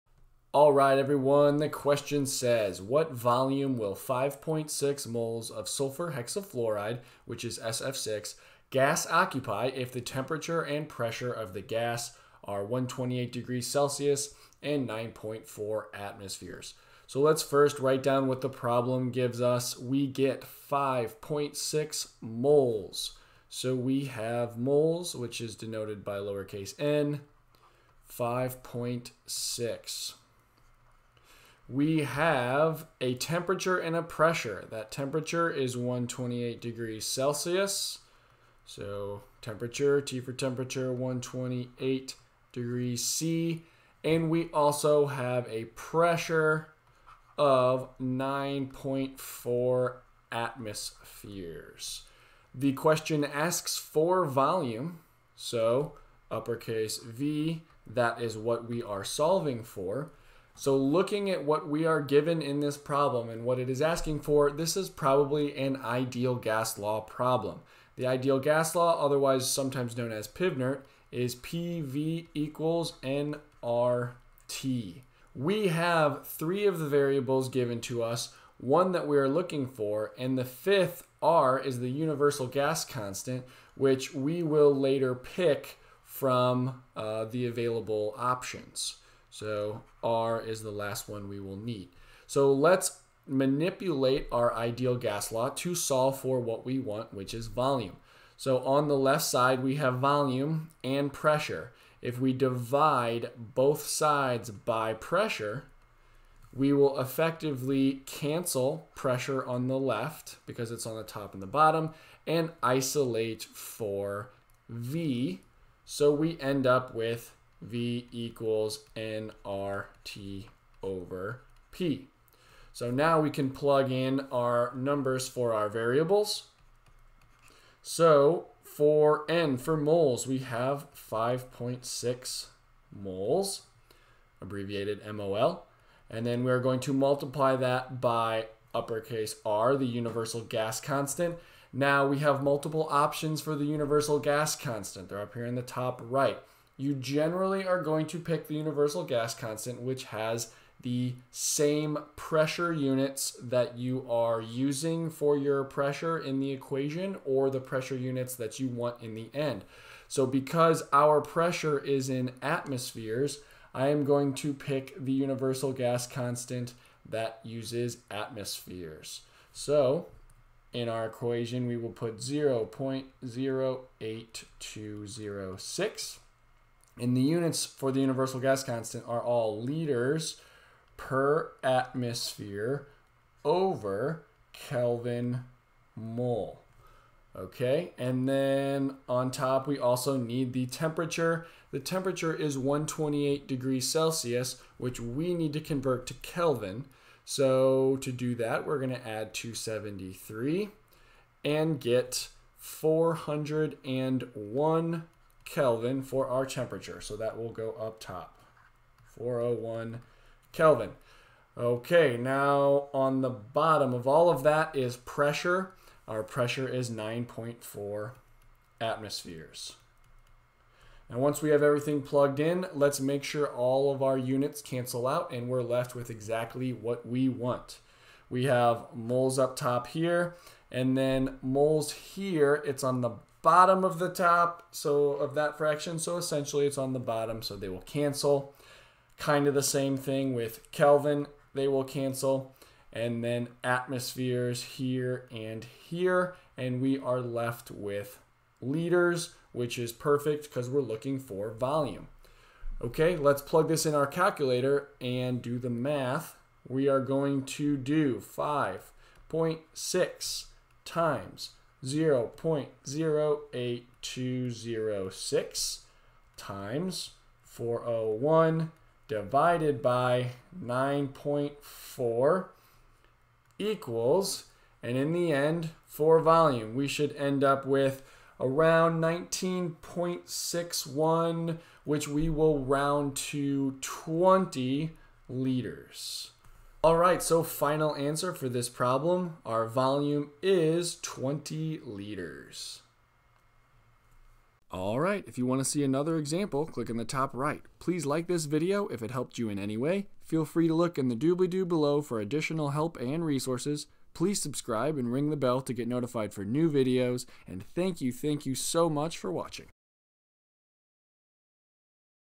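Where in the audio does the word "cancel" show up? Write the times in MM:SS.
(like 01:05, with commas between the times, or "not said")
01:48, 03:44, 03:57, 04:01.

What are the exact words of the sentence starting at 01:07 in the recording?
The ideal gas law, otherwise sometimes known as PIVNERT, is PV equals nRT.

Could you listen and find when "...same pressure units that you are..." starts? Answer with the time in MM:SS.
02:31.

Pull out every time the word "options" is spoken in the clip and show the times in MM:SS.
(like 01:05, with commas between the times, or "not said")
01:28, 02:22.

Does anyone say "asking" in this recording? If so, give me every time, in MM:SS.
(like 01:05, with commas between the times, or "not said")
01:03.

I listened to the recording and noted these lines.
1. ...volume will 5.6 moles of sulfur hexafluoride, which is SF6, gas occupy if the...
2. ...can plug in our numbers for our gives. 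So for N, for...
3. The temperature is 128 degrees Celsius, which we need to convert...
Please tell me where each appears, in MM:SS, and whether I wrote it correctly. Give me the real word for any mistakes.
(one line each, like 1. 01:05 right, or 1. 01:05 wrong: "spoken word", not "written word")
1. 00:03 right
2. 02:03 wrong: "variables", not "gives"
3. 03:11 right.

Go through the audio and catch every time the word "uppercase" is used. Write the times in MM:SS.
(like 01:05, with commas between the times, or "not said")
00:56, 02:18.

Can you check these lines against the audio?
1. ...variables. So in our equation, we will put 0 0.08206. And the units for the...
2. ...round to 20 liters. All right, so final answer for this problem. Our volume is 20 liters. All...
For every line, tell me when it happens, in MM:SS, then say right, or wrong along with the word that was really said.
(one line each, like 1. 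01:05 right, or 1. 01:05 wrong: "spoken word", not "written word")
1. 02:48 wrong: "atmospheres", not "variables"
2. 04:42 right.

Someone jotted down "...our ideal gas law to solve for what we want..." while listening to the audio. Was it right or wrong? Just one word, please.
right.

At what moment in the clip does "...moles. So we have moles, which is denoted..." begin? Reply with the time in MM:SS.
00:22.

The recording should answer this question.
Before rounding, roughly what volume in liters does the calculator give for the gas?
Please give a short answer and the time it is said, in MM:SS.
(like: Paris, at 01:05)
19.61, at 04:39.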